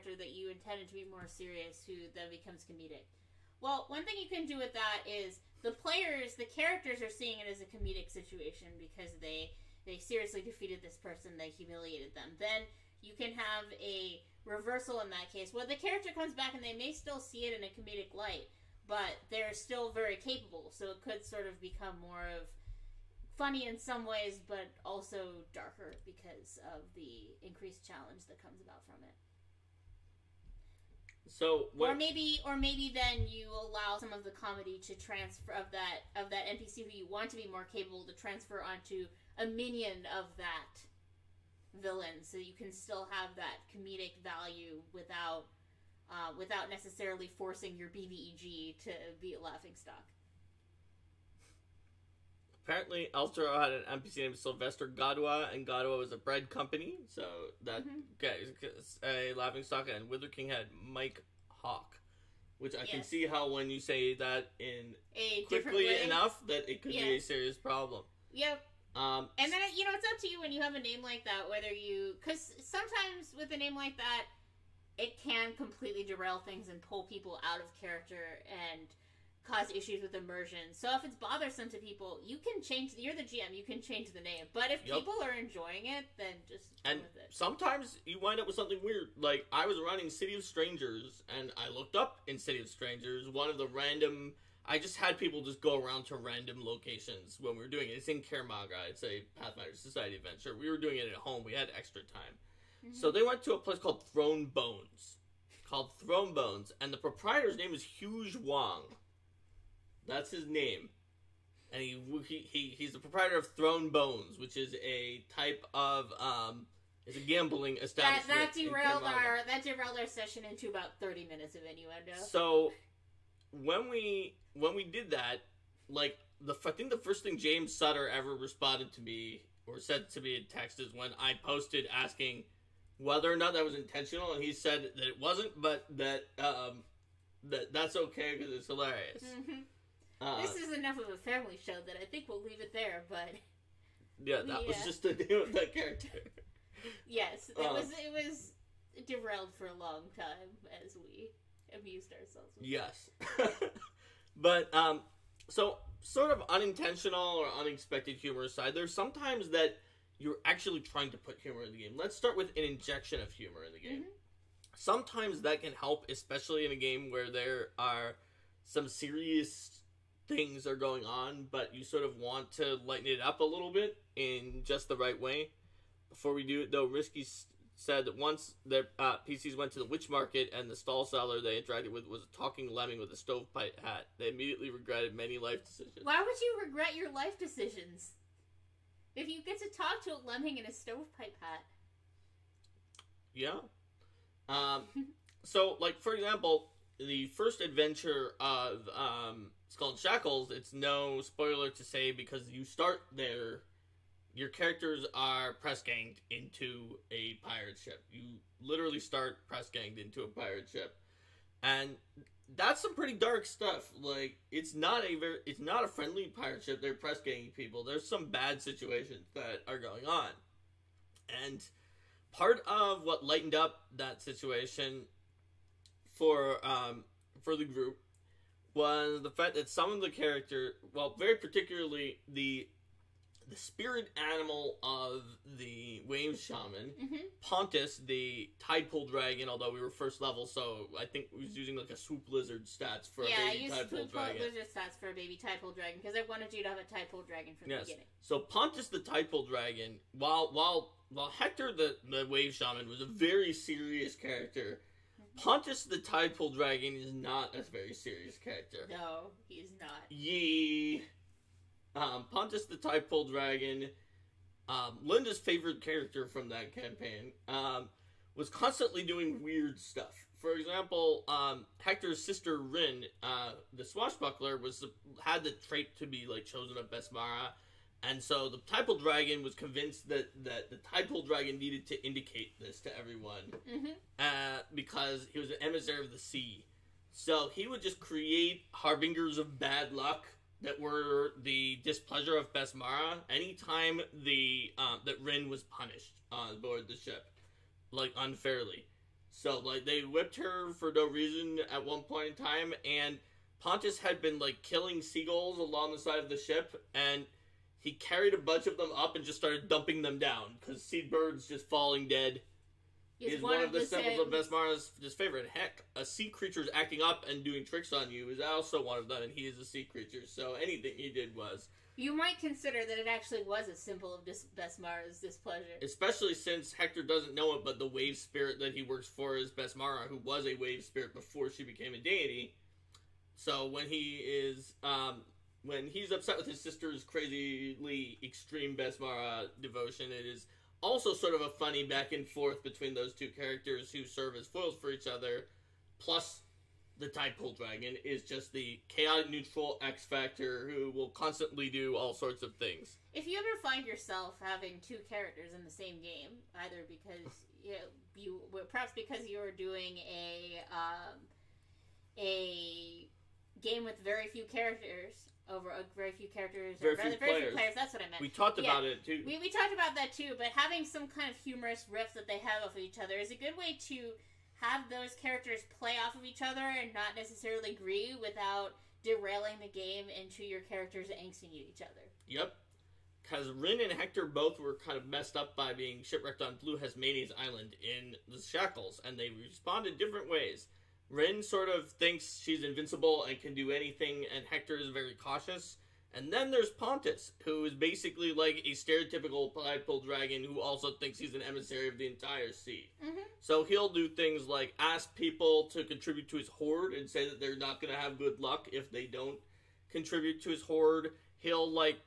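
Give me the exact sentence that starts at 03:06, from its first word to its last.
Why would you regret your life decisions?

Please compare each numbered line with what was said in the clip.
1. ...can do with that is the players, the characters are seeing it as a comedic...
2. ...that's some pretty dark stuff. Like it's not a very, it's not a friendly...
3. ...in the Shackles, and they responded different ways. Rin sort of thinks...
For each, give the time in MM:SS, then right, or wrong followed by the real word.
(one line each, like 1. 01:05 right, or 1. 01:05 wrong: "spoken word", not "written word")
1. 00:04 right
2. 03:32 right
3. 06:27 right.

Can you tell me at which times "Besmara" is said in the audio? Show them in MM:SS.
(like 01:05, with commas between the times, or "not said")
04:36, 04:52, 05:14, 05:24, 05:29, 05:38.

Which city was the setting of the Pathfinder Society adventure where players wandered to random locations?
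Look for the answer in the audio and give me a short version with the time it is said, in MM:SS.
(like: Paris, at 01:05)
Kaer Maga, at 01:38.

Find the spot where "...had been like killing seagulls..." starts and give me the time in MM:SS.
05:03.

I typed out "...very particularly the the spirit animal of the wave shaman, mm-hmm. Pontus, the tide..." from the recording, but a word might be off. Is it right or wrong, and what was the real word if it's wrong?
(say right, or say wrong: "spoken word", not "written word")
right.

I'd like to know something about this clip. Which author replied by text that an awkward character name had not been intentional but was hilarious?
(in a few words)
James Sutter.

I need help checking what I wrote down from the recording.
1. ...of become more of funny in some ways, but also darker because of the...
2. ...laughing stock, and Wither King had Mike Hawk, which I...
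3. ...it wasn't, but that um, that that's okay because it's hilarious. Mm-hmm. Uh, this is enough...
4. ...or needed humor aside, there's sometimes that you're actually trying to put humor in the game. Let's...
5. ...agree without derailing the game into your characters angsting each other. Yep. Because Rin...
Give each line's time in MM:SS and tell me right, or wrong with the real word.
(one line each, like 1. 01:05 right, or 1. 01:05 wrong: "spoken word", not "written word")
1. 00:21 right
2. 00:59 right
3. 02:15 right
4. 02:37 wrong: "unexpected", not "needed"
5. 06:17 right.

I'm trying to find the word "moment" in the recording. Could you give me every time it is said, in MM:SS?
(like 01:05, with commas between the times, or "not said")
not said.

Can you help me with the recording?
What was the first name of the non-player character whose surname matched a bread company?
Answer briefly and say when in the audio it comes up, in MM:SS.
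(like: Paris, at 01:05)
Sylvester, at 00:54.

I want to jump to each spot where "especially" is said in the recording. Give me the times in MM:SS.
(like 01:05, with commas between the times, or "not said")
02:46, 05:25.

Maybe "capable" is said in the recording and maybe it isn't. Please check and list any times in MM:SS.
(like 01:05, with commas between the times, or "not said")
00:20, 00:37.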